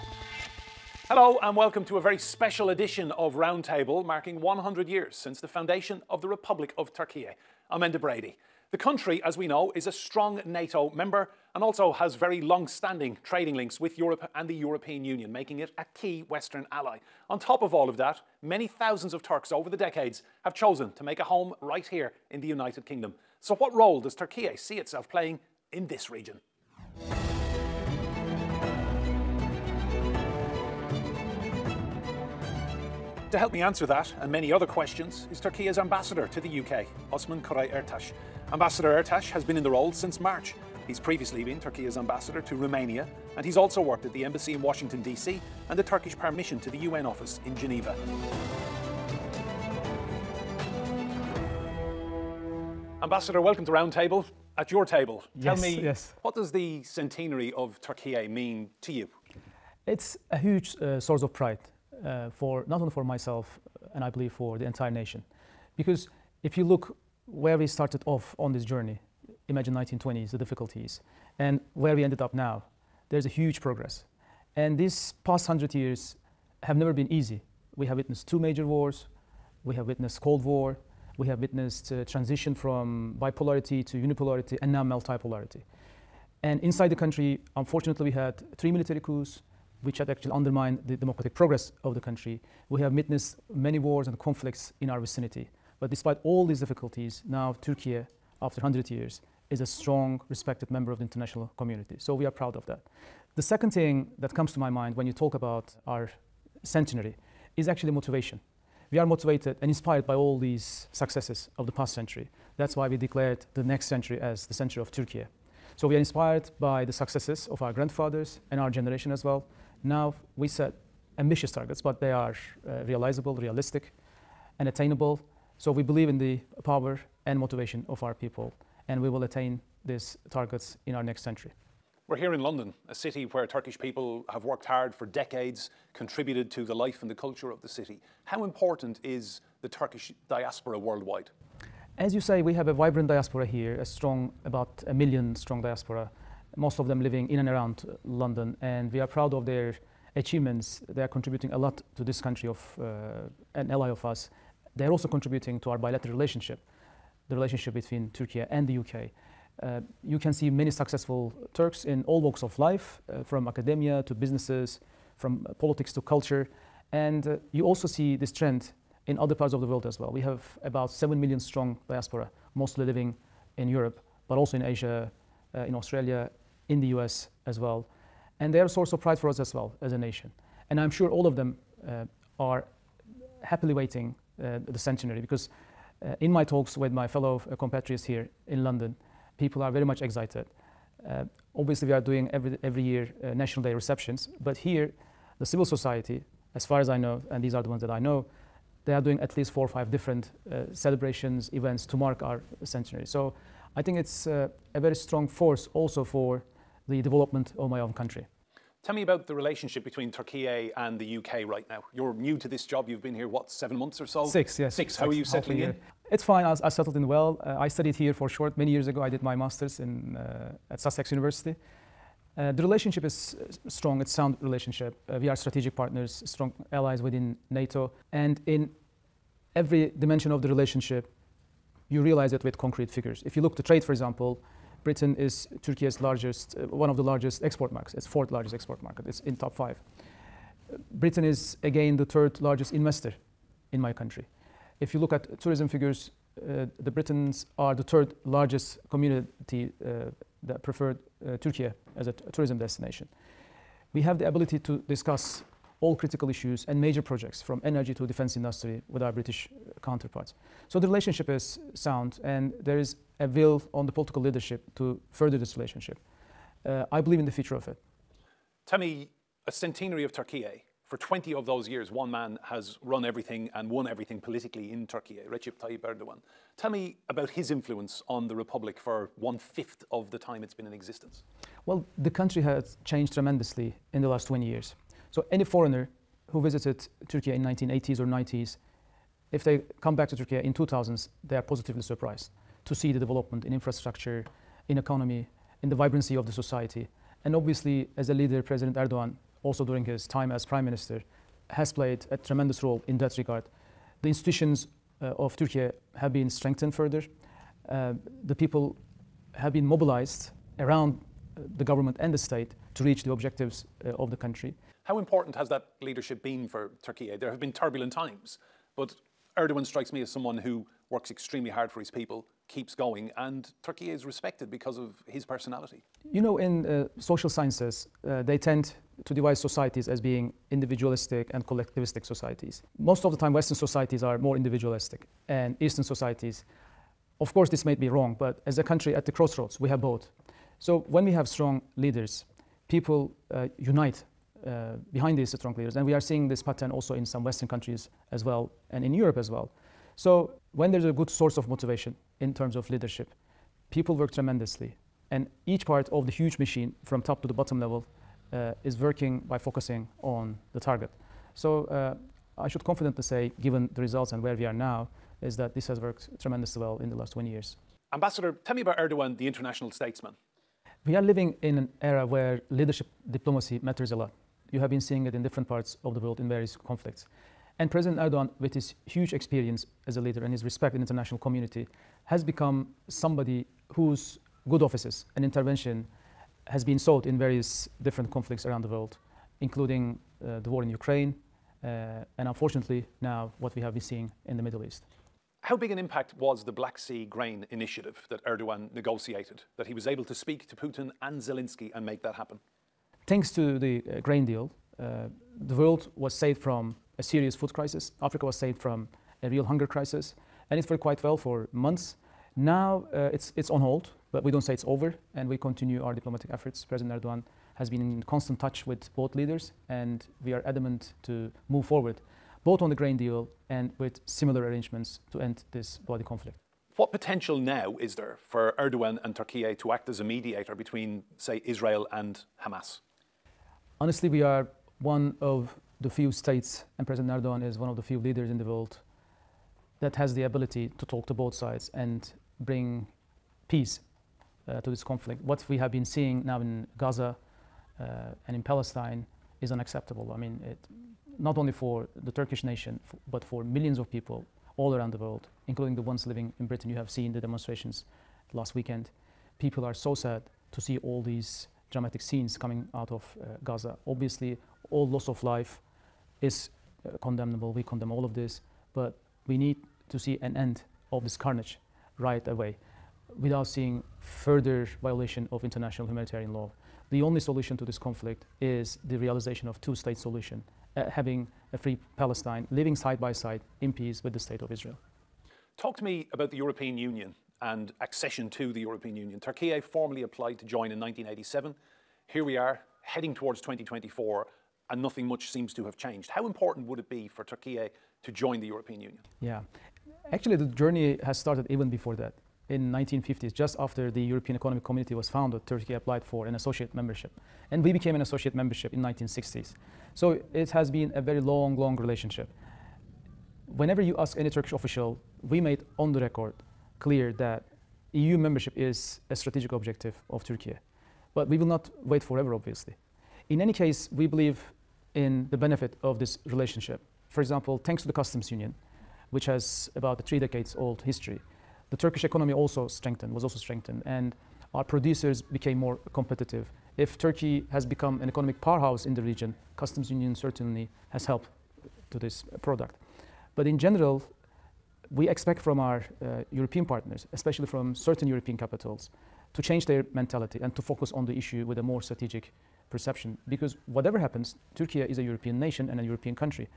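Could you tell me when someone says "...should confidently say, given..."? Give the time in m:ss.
6:02.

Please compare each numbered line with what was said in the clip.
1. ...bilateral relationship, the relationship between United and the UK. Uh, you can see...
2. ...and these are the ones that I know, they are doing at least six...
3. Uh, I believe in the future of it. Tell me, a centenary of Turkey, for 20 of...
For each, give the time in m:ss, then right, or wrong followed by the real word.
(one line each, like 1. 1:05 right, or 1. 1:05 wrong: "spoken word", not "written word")
1. 2:35 wrong: "Turkey", not "United"
2. 3:17 wrong: "four", not "six"
3. 4:26 right.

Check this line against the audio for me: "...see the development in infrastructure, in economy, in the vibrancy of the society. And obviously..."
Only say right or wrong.
right.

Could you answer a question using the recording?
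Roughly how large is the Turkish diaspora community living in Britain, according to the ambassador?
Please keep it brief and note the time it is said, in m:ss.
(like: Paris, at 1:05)
about 1 million, at 2:24.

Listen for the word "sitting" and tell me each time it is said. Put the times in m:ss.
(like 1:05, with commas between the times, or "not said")
not said.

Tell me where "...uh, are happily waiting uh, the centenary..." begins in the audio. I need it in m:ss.
3:01.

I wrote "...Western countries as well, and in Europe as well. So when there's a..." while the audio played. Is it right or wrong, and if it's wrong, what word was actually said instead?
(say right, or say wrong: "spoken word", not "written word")
right.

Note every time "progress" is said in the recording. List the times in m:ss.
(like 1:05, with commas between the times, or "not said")
1:13, 1:31.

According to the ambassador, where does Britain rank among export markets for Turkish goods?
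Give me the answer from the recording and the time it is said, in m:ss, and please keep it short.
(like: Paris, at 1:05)
4th largest, at 3:58.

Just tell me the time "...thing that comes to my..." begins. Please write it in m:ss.
1:43.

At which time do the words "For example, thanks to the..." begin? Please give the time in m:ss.
8:47.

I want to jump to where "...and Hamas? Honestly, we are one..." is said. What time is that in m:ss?
7:11.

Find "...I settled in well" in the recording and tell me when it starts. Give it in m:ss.
3:36.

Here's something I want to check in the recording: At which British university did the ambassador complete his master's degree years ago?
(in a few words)
Sussex University.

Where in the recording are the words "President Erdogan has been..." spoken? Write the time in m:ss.
6:56.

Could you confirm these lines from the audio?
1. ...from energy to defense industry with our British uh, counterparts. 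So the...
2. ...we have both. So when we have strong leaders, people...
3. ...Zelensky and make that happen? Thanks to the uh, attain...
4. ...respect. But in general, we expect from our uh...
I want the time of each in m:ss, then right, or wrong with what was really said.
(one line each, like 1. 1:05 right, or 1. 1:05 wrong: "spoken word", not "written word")
1. 4:17 right
2. 5:39 right
3. 6:41 wrong: "grain", not "attain"
4. 9:02 wrong: "product", not "respect".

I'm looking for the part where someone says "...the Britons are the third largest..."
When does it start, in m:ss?
4:06.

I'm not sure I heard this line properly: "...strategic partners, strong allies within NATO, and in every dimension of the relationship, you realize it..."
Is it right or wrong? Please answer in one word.
right.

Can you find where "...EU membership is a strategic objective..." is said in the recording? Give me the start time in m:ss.
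8:37.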